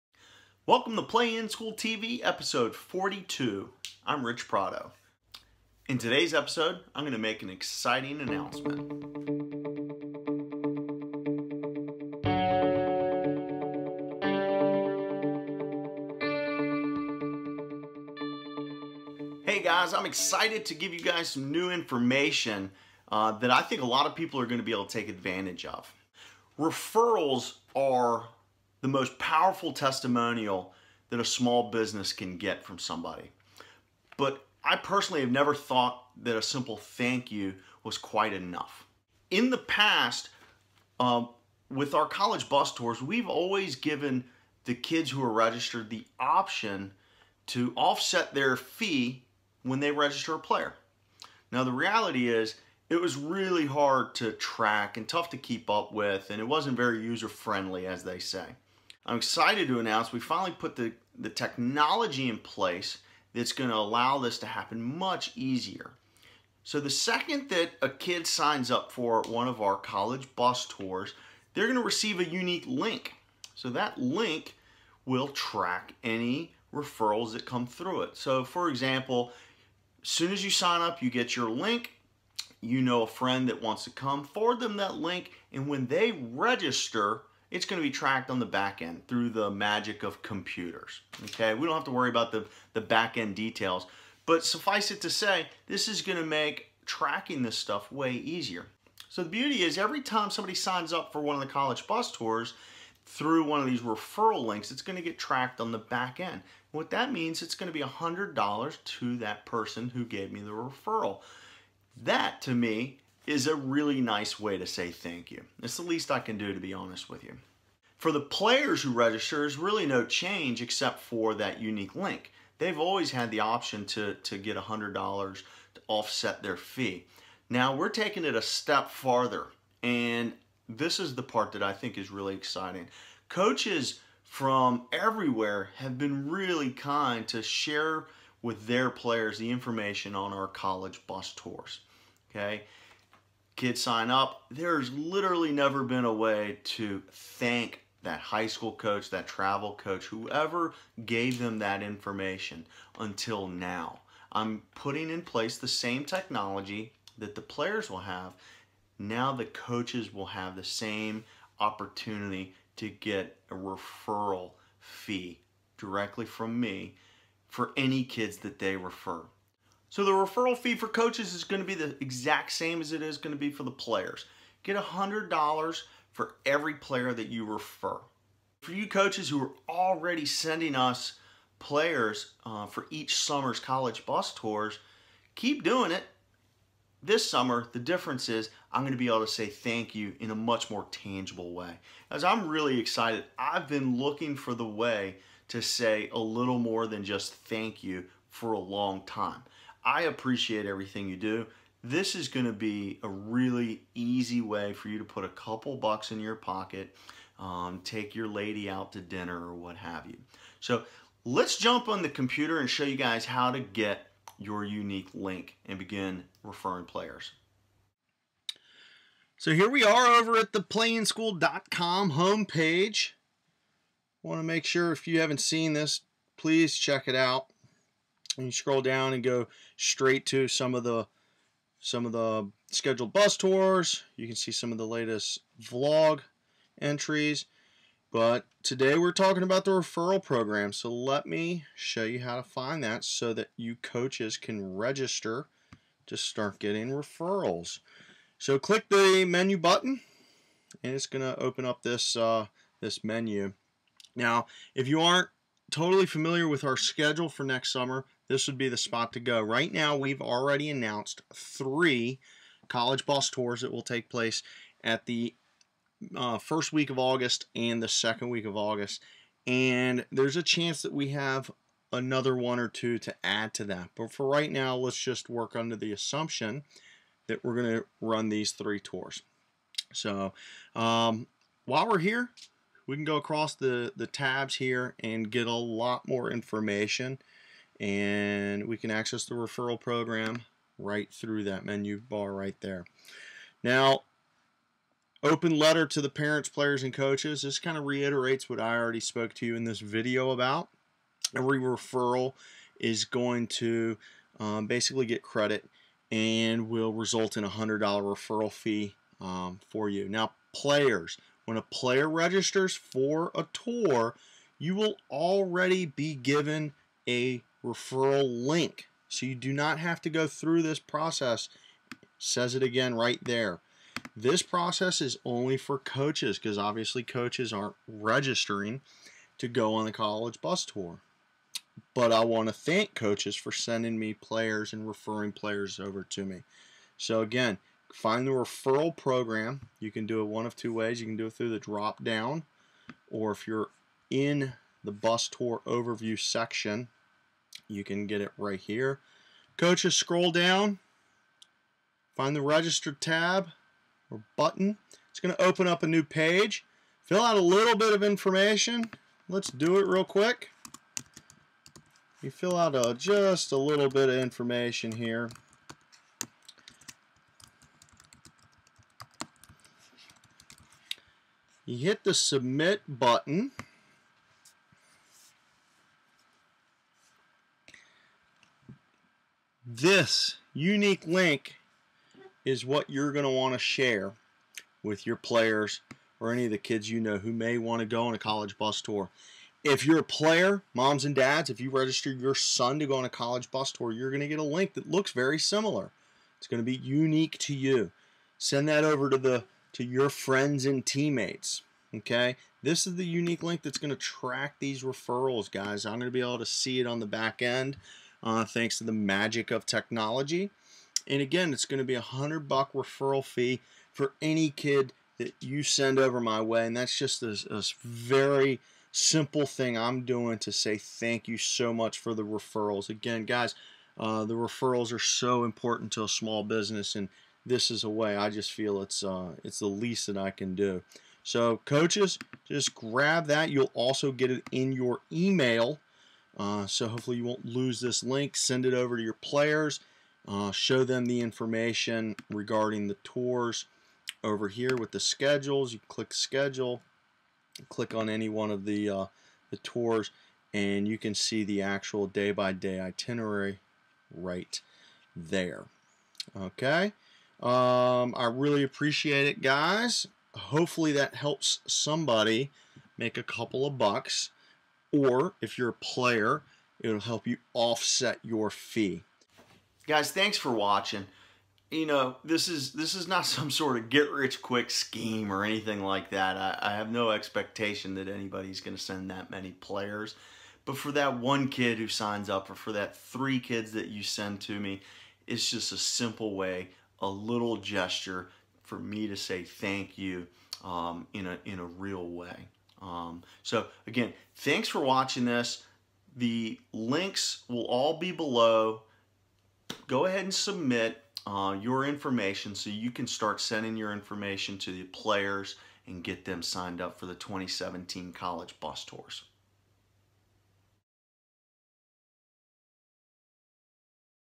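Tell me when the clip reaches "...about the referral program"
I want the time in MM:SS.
03:59.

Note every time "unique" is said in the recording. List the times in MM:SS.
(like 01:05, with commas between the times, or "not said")
01:12, 02:01, 03:34, 06:20, 06:36, 06:43.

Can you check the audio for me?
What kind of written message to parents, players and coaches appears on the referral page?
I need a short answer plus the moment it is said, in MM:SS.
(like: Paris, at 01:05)
open letter, at 04:55.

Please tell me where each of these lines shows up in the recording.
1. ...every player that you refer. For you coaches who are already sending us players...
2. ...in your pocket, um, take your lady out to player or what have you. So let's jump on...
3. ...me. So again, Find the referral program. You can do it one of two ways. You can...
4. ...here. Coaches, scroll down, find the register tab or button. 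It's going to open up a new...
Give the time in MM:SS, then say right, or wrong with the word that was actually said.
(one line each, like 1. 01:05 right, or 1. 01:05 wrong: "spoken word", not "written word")
1. 02:56 right
2. 03:26 wrong: "dinner", not "player"
3. 05:36 right
4. 05:48 right.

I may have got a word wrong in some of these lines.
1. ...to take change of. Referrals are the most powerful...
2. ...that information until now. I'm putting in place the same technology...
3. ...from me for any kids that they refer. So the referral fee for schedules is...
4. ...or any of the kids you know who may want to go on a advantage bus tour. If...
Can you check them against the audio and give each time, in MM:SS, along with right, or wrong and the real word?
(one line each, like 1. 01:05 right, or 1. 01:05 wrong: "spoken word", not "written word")
1. 00:24 wrong: "advantage", not "change"
2. 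02:31 right
3. 02:46 wrong: "coaches", not "schedules"
4. 06:26 wrong: "college", not "advantage".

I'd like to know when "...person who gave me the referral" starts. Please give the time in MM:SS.
01:49.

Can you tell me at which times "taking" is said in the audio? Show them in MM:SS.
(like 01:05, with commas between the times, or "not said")
02:07.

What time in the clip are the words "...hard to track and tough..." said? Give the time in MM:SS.
00:53.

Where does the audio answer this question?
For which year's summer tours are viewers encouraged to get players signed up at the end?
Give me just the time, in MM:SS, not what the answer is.
08:27.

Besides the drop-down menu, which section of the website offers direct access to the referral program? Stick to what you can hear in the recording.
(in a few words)
bus tour overview.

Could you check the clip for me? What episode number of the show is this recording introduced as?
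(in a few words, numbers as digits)
42.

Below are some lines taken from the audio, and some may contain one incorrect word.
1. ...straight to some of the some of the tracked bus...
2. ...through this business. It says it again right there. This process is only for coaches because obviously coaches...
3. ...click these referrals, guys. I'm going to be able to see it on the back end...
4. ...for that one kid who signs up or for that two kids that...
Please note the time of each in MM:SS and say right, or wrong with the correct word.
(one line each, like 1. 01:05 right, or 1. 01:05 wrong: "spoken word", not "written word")
1. 03:49 wrong: "scheduled", not "tracked"
2. 05:20 wrong: "process", not "business"
3. 06:43 wrong: "track", not "click"
4. 08:00 wrong: "three", not "two".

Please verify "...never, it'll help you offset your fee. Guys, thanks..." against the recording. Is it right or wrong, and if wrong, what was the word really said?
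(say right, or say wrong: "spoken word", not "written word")
wrong: "player", not "never".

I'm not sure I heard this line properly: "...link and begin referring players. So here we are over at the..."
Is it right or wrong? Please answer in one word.
right.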